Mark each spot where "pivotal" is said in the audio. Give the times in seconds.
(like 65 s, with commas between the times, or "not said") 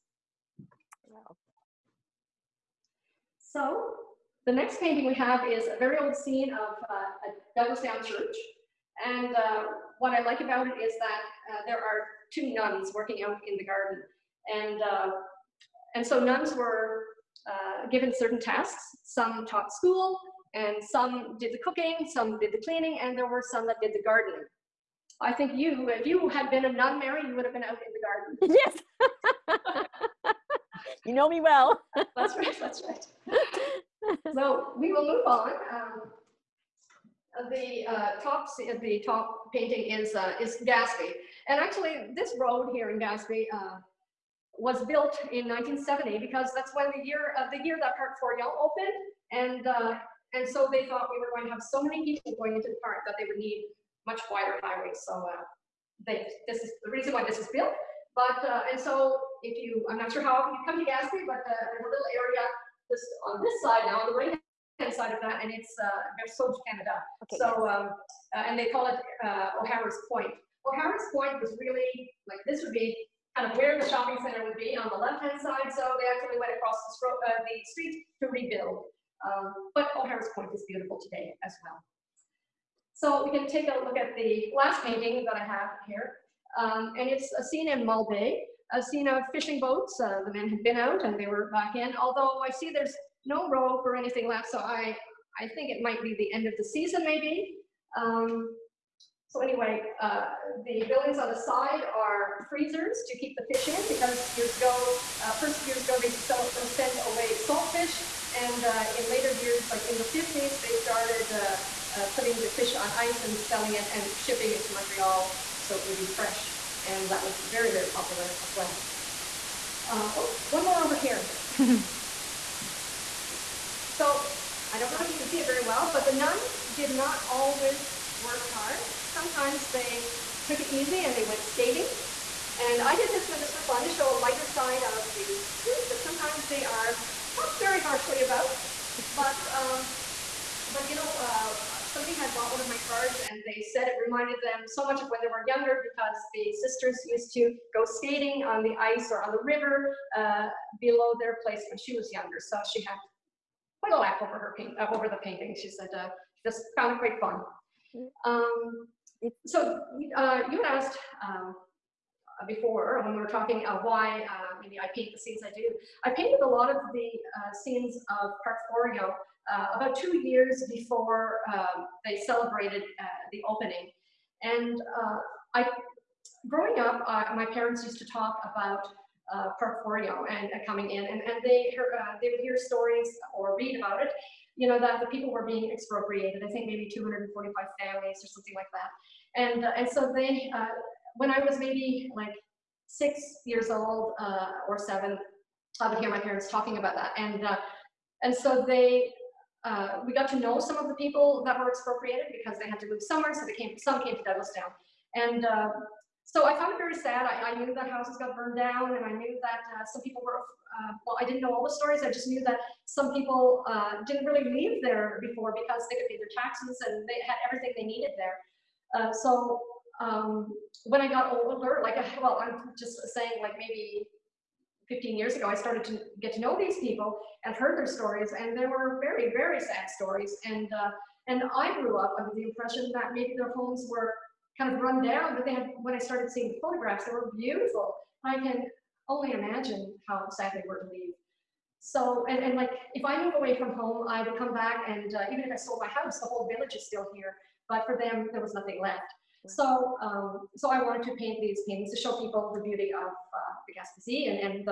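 not said.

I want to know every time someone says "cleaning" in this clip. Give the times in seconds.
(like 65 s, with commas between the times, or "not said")
22 s.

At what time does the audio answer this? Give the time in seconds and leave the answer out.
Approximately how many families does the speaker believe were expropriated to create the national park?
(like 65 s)
186 s.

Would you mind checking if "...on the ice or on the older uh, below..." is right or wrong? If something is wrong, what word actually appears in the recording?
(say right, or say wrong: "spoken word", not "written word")
wrong: "river", not "older".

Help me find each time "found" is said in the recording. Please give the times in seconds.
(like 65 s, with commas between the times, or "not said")
156 s, 206 s.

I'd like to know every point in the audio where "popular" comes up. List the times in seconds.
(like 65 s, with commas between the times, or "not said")
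117 s.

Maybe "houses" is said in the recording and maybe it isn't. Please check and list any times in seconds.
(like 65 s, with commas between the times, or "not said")
207 s, 245 s.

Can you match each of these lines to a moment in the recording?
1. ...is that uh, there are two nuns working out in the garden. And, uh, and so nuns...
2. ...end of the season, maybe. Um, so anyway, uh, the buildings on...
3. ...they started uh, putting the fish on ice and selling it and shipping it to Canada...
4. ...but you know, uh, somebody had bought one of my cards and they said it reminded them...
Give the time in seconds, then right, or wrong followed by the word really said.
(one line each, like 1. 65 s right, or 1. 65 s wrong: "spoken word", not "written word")
1. 10 s right
2. 96 s right
3. 110 s wrong: "Montreal", not "Canada"
4. 140 s right.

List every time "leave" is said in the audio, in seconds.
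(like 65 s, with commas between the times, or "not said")
214 s, 240 s.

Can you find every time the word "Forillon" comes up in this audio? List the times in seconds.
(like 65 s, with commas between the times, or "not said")
48 s, 168 s.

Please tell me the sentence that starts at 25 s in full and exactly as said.
I think you, if you had been a nun, Mary, you would have been out in the garden.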